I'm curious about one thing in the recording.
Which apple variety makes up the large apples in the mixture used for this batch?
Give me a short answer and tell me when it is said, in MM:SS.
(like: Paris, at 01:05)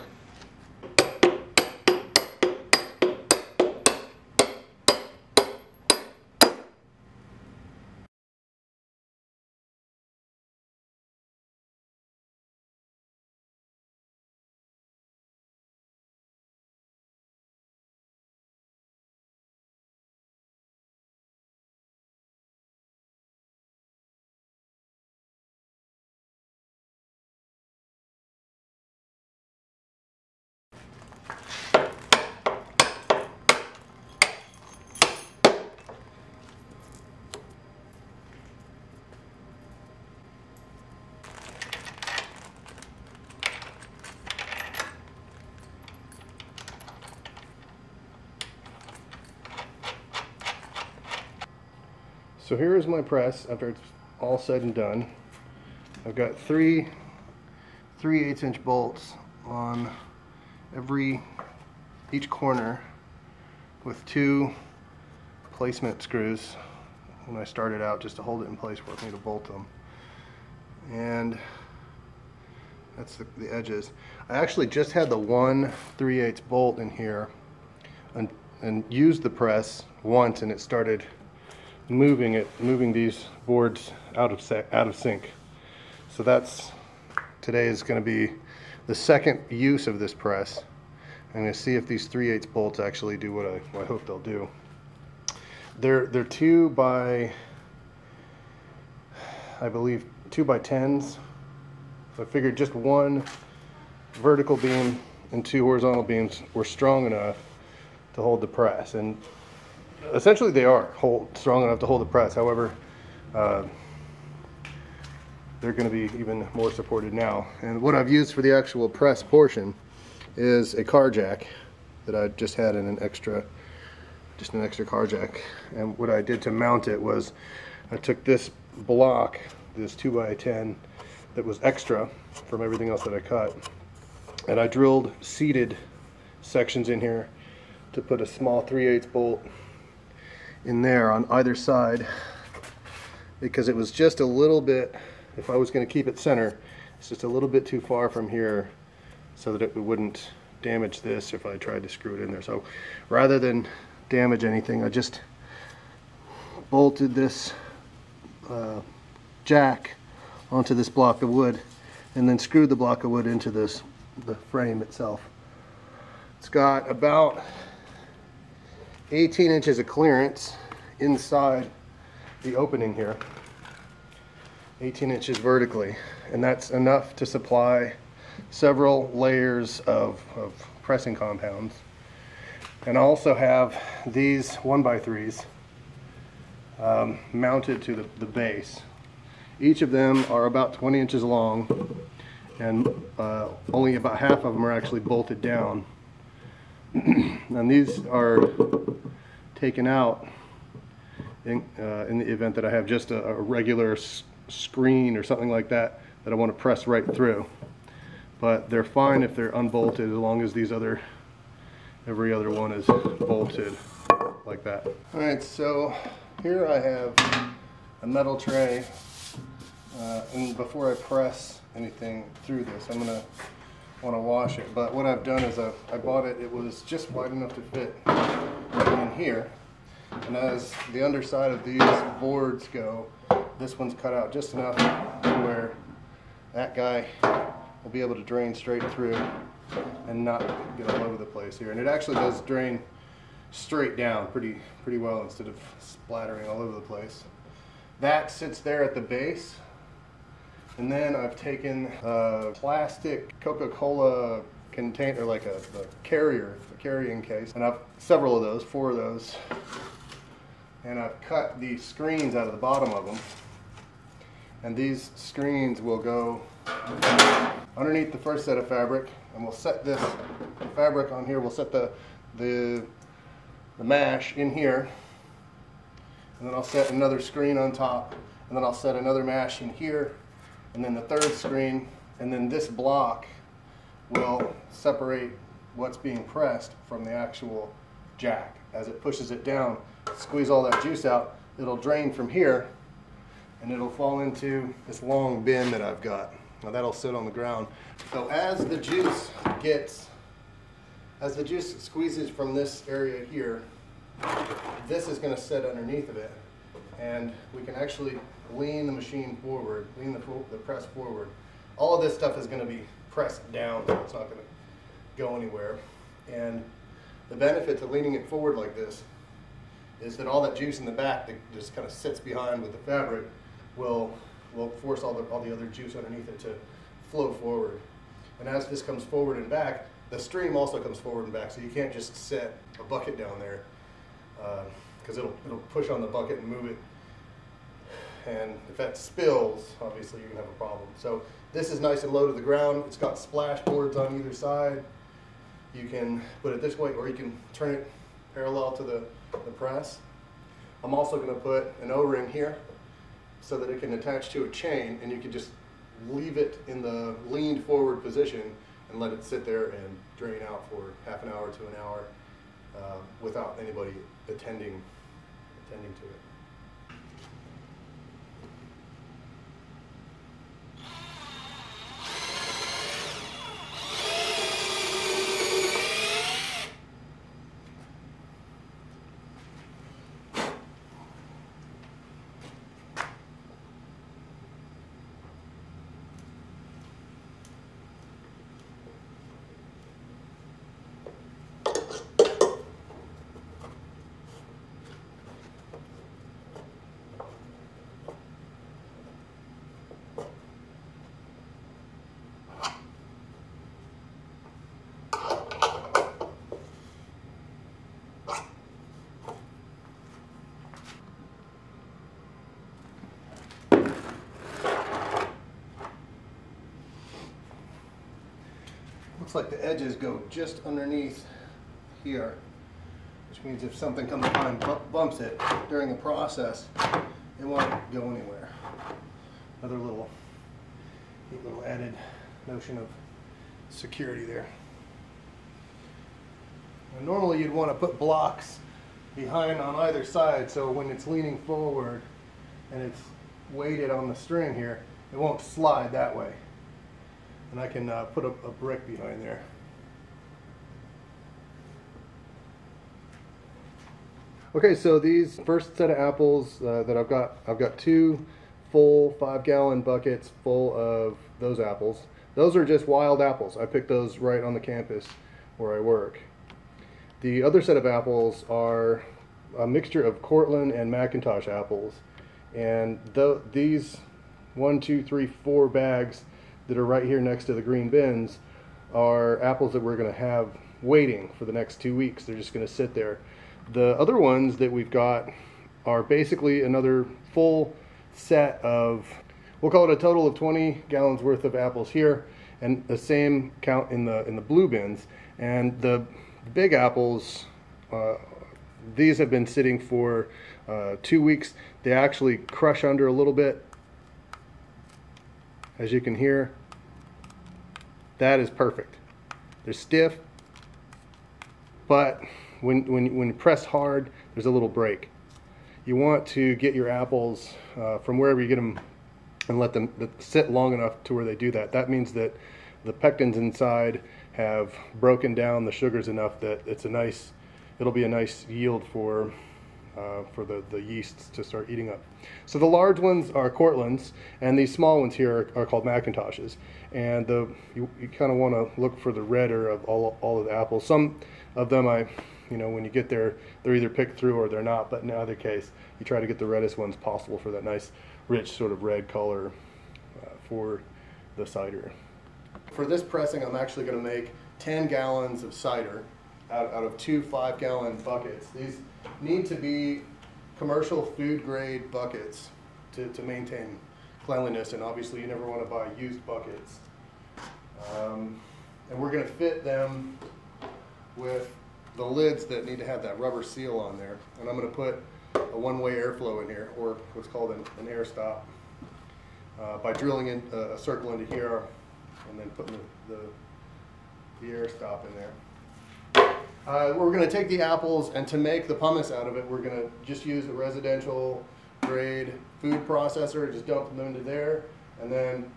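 Cortland, at 08:53.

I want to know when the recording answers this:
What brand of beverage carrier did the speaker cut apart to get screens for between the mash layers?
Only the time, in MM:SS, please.
04:13.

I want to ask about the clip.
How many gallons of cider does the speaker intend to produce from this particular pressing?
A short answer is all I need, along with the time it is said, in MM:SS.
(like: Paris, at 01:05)
10, at 09:14.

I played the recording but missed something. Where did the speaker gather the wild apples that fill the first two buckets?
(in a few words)
campus where I work.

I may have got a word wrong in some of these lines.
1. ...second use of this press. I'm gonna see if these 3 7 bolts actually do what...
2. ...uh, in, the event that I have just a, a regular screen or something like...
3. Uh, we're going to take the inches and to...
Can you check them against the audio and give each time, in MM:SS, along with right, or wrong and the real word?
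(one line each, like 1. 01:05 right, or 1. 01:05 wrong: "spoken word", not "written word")
1. 01:28 wrong: "8", not "7"
2. 03:21 right
3. 09:46 wrong: "apples", not "inches".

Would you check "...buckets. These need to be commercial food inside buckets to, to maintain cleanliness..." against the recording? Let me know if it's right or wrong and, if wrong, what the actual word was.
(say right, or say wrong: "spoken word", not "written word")
wrong: "grade", not "inside".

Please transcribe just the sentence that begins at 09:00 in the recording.
Some of them, I, you know, when you get there, they're either picked through or they're not.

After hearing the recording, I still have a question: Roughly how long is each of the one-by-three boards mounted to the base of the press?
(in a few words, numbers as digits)
20 inches.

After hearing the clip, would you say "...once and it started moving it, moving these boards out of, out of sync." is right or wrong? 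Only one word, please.
right.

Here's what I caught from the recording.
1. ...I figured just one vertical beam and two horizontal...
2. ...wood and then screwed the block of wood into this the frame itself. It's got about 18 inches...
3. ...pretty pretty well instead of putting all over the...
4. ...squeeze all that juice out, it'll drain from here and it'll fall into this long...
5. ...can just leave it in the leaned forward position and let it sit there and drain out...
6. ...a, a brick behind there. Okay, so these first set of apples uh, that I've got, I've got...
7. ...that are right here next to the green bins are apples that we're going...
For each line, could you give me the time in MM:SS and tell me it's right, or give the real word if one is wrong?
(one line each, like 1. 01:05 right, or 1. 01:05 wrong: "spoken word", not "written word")
1. 01:42 right
2. 02:41 right
3. 04:04 wrong: "splattering", not "putting"
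4. 04:50 right
5. 05:55 right
6. 07:28 right
7. 07:56 right.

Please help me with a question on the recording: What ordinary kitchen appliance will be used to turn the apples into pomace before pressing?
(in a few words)
food processor.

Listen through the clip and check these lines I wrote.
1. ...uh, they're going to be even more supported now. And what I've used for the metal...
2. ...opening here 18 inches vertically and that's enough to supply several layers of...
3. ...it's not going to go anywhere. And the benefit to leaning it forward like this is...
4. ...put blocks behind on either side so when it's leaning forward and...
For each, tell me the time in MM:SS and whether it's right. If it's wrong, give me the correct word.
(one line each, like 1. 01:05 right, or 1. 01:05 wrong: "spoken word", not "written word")
1. 01:53 wrong: "actual", not "metal"
2. 02:52 right
3. 05:13 right
4. 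07:17 right.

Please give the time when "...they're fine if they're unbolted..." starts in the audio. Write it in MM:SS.
03:28.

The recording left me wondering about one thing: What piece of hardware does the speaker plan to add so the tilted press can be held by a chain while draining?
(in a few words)
O-ring.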